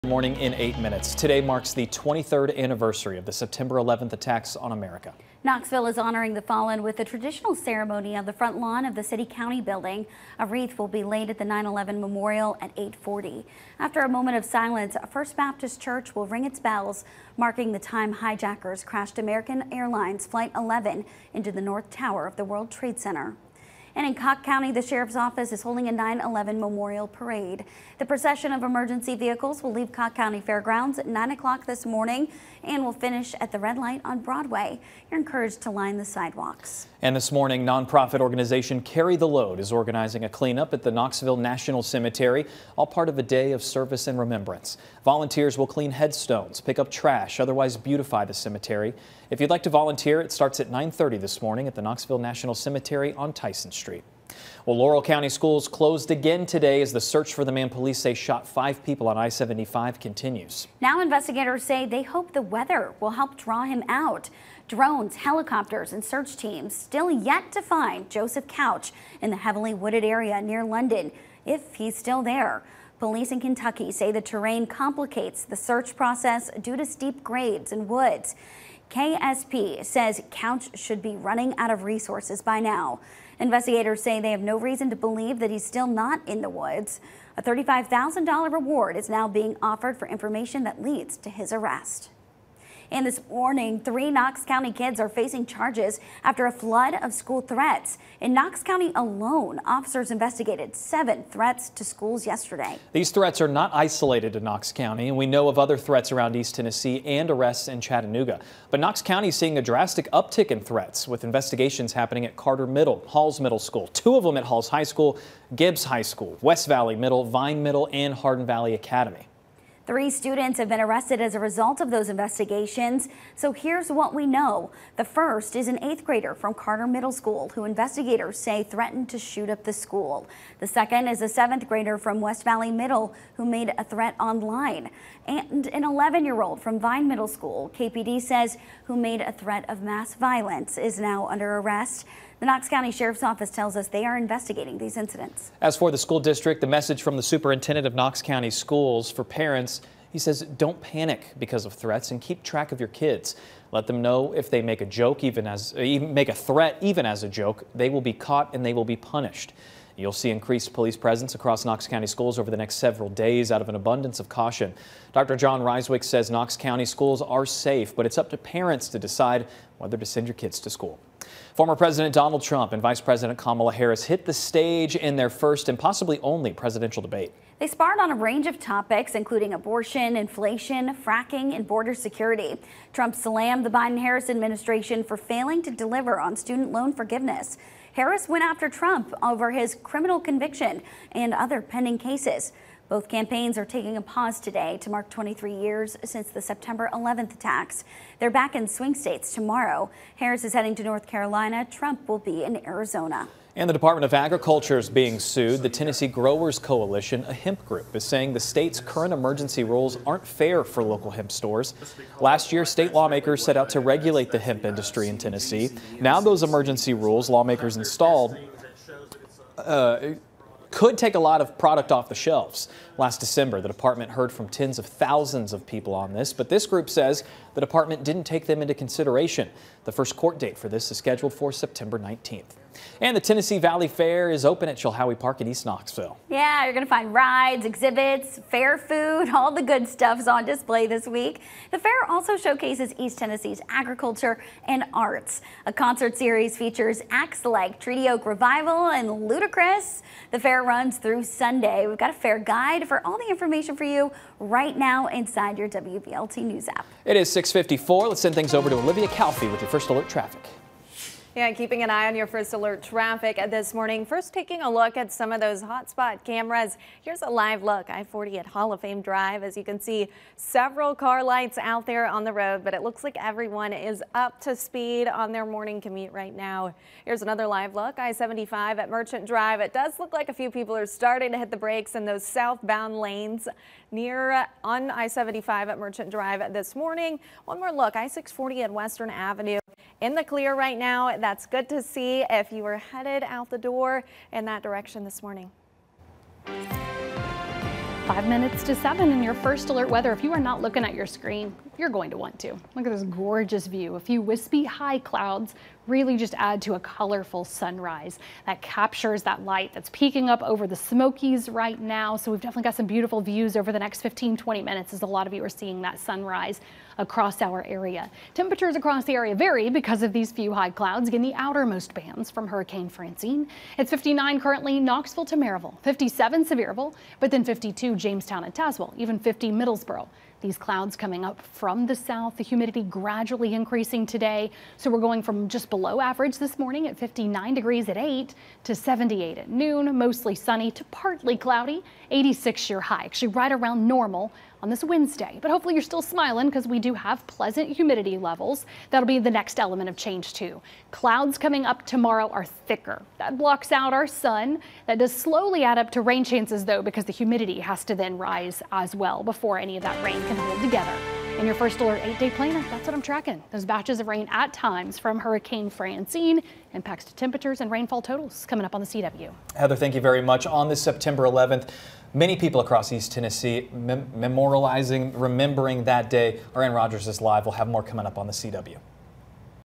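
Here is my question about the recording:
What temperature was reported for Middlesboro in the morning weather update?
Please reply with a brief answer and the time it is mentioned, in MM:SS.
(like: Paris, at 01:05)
50, at 05:29.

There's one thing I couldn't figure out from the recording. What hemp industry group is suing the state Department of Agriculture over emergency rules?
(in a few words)
Tennessee Growers Coalition.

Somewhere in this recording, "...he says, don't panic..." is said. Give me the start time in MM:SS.
02:30.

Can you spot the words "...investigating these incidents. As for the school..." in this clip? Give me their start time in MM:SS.
02:24.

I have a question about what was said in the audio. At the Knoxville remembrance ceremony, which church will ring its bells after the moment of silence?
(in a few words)
First Baptist Church.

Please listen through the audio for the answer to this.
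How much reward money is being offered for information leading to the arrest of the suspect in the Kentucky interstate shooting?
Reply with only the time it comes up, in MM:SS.
01:27.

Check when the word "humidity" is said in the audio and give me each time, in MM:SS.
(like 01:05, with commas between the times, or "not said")
05:32, 05:47, 05:57.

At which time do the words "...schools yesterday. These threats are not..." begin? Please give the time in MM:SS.
01:41.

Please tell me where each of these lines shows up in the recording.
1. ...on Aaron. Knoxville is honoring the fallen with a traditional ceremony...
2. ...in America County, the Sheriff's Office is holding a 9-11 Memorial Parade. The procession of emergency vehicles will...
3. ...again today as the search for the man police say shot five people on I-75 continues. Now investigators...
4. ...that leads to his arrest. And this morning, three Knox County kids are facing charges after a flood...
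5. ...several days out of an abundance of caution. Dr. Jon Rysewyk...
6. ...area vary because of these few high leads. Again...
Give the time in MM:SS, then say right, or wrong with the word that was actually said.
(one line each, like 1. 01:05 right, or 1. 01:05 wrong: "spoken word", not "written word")
1. 00:04 wrong: "America", not "Aaron"
2. 00:24 wrong: "Cocke", not "America"
3. 00:56 right
4. 01:30 right
5. 02:42 right
6. 05:19 wrong: "clouds", not "leads".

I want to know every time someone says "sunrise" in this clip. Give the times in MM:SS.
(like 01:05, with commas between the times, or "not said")
05:07, 05:15.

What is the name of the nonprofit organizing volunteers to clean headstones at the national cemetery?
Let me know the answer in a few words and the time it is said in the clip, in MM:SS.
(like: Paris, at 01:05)
Carry the Load, at 00:38.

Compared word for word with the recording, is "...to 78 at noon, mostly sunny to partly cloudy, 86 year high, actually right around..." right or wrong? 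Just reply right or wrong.
right.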